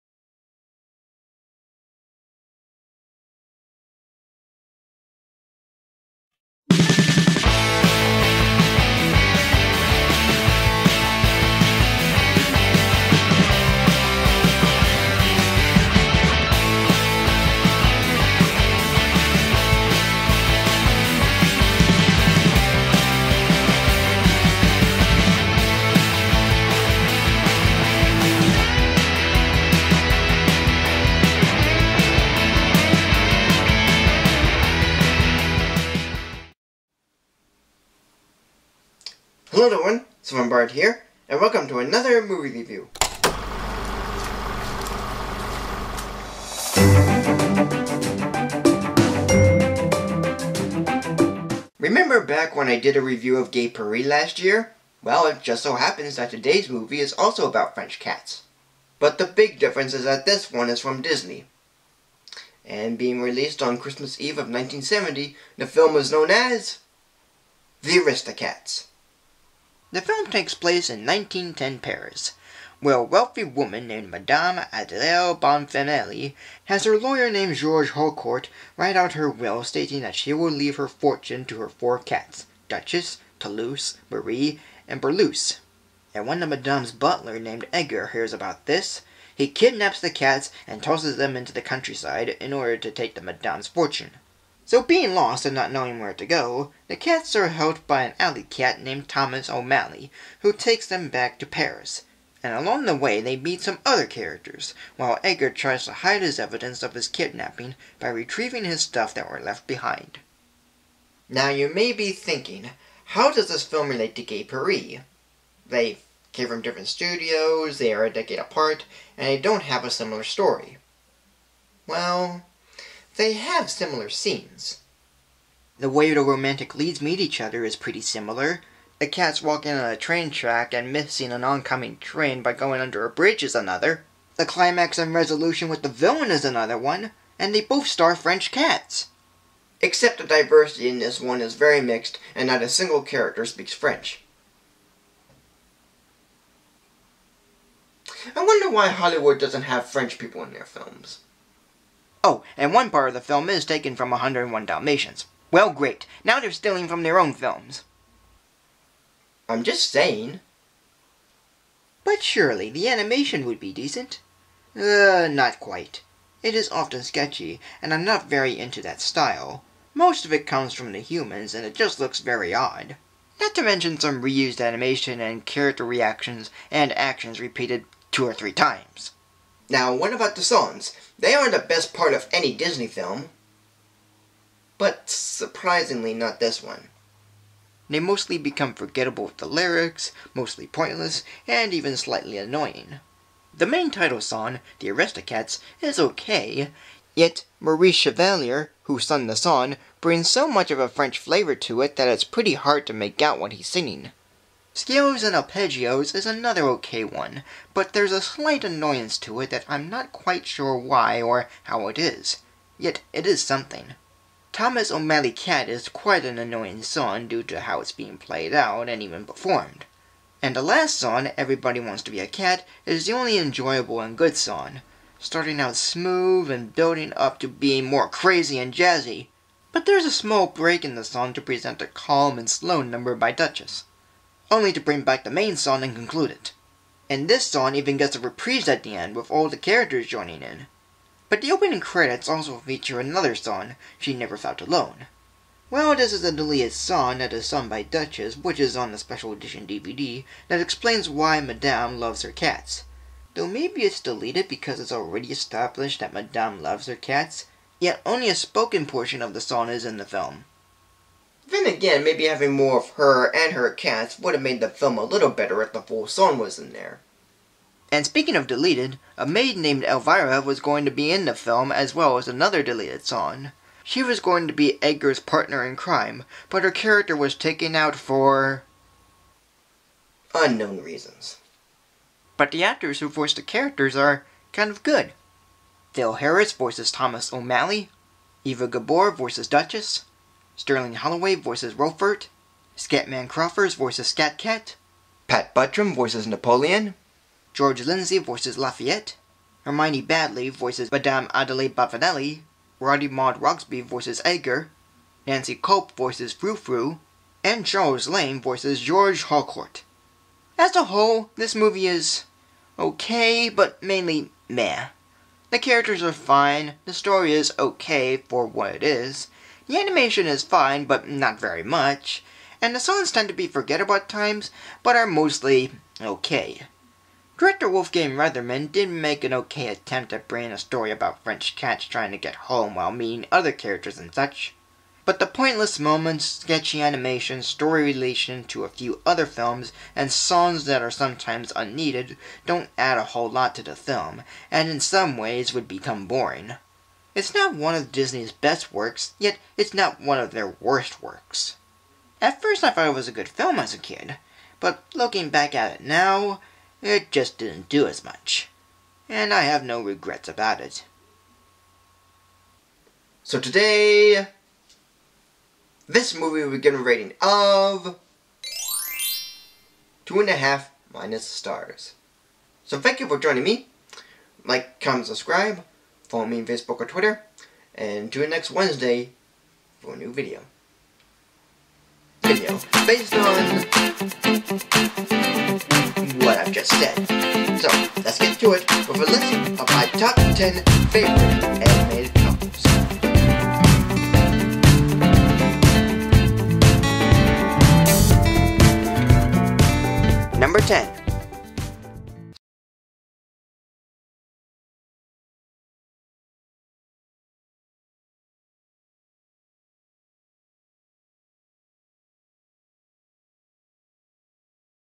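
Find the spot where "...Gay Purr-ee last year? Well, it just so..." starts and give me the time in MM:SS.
00:53.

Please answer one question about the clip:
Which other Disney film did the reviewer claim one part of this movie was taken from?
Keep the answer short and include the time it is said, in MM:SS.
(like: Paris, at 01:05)
101 Dalmatians, at 02:34.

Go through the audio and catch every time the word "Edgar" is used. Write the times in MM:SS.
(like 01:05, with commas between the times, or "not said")
01:27, 01:45, 04:34, 05:04.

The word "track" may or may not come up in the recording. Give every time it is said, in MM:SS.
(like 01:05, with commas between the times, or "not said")
02:10.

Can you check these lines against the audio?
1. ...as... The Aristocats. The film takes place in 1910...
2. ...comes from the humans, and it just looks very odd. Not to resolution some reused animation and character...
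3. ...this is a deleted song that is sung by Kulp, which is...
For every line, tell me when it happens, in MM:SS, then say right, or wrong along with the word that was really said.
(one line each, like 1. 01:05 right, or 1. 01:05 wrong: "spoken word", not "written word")
1. 01:06 right
2. 02:50 wrong: "mention", not "resolution"
3. 04:05 wrong: "Duchess", not "Kulp".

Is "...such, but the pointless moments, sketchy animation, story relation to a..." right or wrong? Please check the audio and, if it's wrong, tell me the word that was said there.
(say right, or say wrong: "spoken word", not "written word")
right.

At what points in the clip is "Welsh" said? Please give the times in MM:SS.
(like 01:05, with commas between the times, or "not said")
not said.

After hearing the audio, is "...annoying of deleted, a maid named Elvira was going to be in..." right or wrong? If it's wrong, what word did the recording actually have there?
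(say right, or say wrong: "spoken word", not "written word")
wrong: "speaking", not "annoying".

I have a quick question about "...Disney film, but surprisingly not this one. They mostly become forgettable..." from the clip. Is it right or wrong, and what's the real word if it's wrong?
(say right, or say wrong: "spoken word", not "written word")
right.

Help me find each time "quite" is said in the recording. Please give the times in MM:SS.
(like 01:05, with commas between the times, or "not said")
02:45, 03:30, 03:35.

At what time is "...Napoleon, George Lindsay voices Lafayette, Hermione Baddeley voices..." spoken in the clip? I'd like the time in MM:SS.
04:56.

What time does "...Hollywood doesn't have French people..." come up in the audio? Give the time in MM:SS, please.
02:28.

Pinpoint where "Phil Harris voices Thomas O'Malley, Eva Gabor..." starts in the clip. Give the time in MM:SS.
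04:45.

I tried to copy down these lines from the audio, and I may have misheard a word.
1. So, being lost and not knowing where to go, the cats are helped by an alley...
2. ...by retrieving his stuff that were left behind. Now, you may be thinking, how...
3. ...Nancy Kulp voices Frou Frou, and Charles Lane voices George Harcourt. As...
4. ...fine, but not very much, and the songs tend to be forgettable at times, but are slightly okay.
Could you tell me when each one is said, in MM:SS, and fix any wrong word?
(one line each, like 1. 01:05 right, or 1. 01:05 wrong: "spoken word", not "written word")
1. 01:34 right
2. 01:47 right
3. 05:05 right
4. 05:20 wrong: "mostly", not "slightly".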